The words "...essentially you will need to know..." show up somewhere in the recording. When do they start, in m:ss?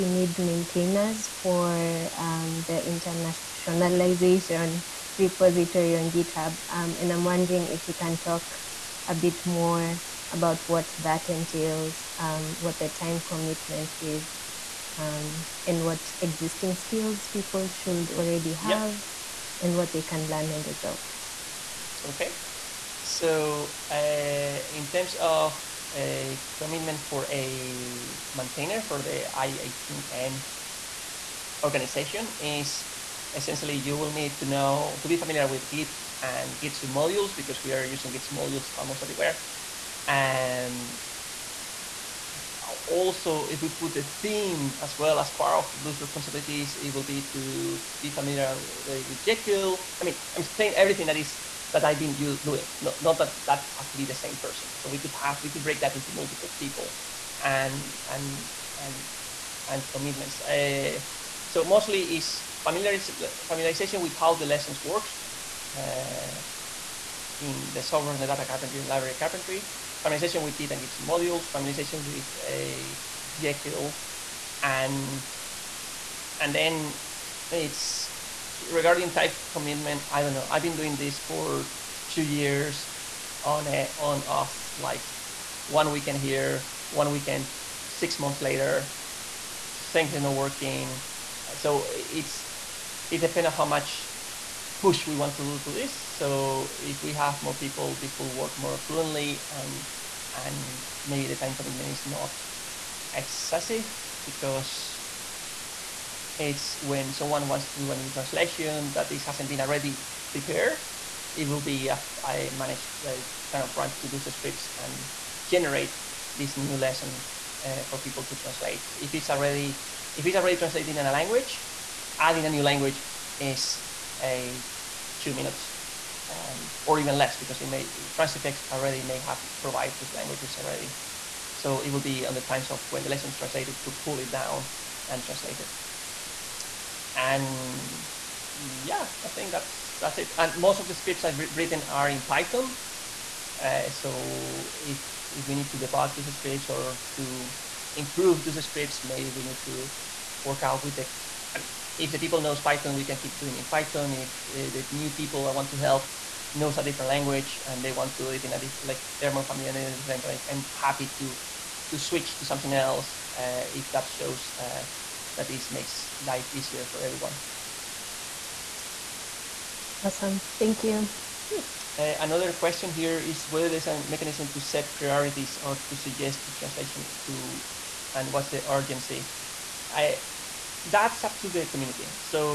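0:33.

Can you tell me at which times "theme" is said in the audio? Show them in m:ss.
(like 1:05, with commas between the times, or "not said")
0:44.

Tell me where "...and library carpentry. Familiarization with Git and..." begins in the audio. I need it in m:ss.
1:08.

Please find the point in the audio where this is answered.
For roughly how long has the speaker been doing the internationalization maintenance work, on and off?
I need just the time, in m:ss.
1:22.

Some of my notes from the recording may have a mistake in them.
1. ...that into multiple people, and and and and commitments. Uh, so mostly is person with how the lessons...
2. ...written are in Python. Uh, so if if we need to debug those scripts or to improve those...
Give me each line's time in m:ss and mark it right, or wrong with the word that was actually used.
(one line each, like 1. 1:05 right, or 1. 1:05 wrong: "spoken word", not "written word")
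1. 0:55 wrong: "familiarization", not "person"
2. 2:21 right.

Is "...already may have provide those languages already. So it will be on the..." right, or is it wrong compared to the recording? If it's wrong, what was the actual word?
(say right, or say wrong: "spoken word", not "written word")
right.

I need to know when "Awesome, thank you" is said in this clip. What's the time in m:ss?
2:50.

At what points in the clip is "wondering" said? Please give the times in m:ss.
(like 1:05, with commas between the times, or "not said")
0:07.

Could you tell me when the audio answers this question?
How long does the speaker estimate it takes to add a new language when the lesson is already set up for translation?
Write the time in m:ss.
2:05.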